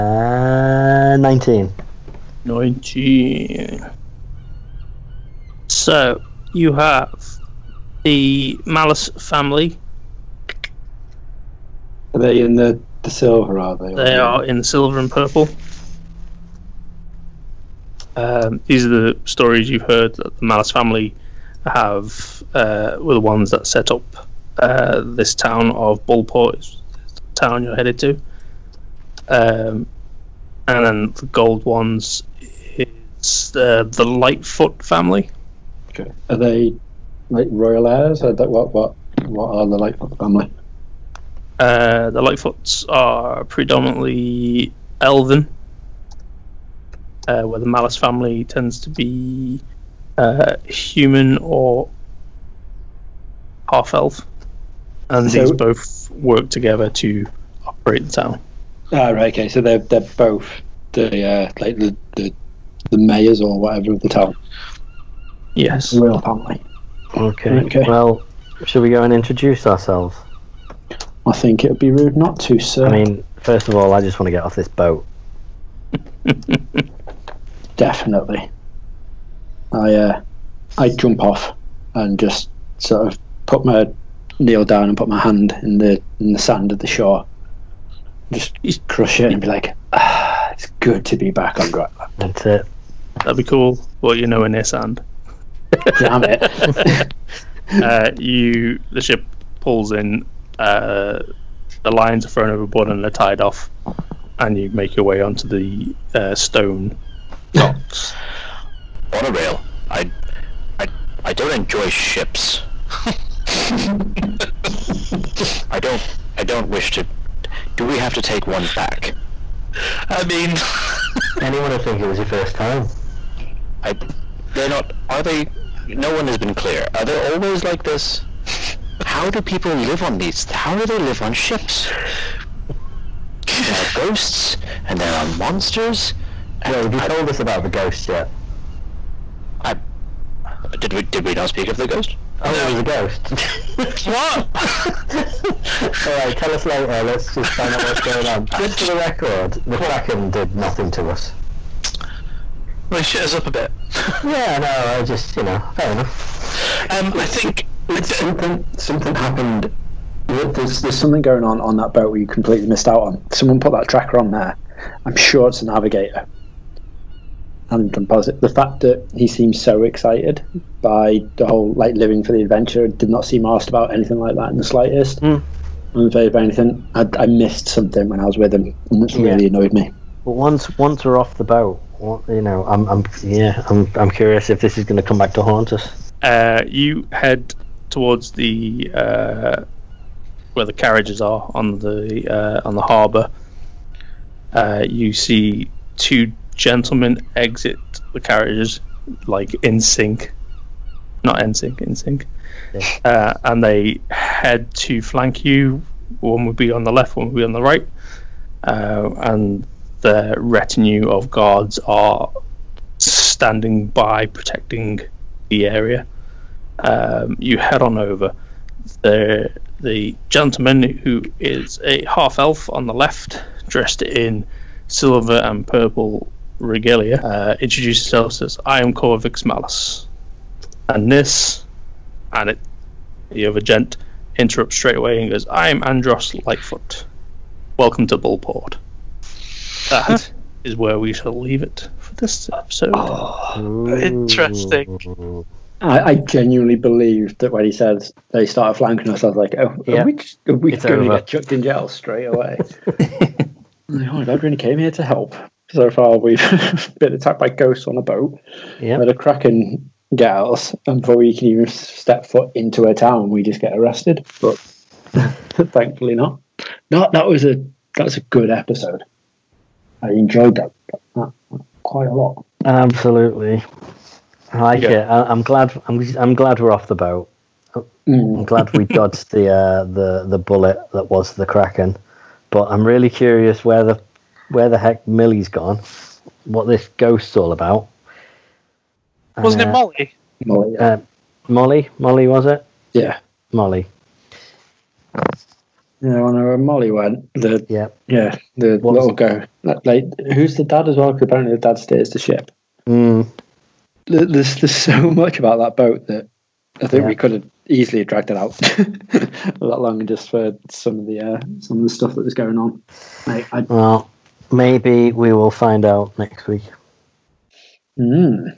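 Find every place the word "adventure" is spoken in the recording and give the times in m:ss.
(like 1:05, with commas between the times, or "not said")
2:52.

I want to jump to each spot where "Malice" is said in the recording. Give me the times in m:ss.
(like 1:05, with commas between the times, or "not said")
0:08, 0:20, 0:47.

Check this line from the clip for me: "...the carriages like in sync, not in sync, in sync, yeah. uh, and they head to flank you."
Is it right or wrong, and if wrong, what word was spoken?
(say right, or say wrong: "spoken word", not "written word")
right.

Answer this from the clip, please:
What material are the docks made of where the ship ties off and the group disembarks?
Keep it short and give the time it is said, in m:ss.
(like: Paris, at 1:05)
Stone, at 1:46.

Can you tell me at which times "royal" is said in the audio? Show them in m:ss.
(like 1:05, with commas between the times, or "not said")
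0:37.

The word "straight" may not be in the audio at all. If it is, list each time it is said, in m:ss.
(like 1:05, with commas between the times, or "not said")
3:54, 4:11.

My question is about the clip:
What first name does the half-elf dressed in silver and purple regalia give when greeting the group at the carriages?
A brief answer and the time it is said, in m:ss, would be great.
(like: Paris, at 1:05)
Corvix, at 3:48.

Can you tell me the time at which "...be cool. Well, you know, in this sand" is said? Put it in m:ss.
1:33.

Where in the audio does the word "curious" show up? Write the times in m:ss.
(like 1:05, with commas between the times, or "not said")
3:04, 4:43.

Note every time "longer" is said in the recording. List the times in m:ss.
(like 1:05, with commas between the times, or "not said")
5:09.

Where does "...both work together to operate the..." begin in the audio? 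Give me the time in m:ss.
0:55.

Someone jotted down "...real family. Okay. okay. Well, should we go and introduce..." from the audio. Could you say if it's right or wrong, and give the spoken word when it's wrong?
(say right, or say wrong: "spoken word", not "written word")
right.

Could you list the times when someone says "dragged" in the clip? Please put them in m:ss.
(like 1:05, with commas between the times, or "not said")
5:08.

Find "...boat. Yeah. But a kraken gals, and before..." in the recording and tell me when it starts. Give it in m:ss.
4:18.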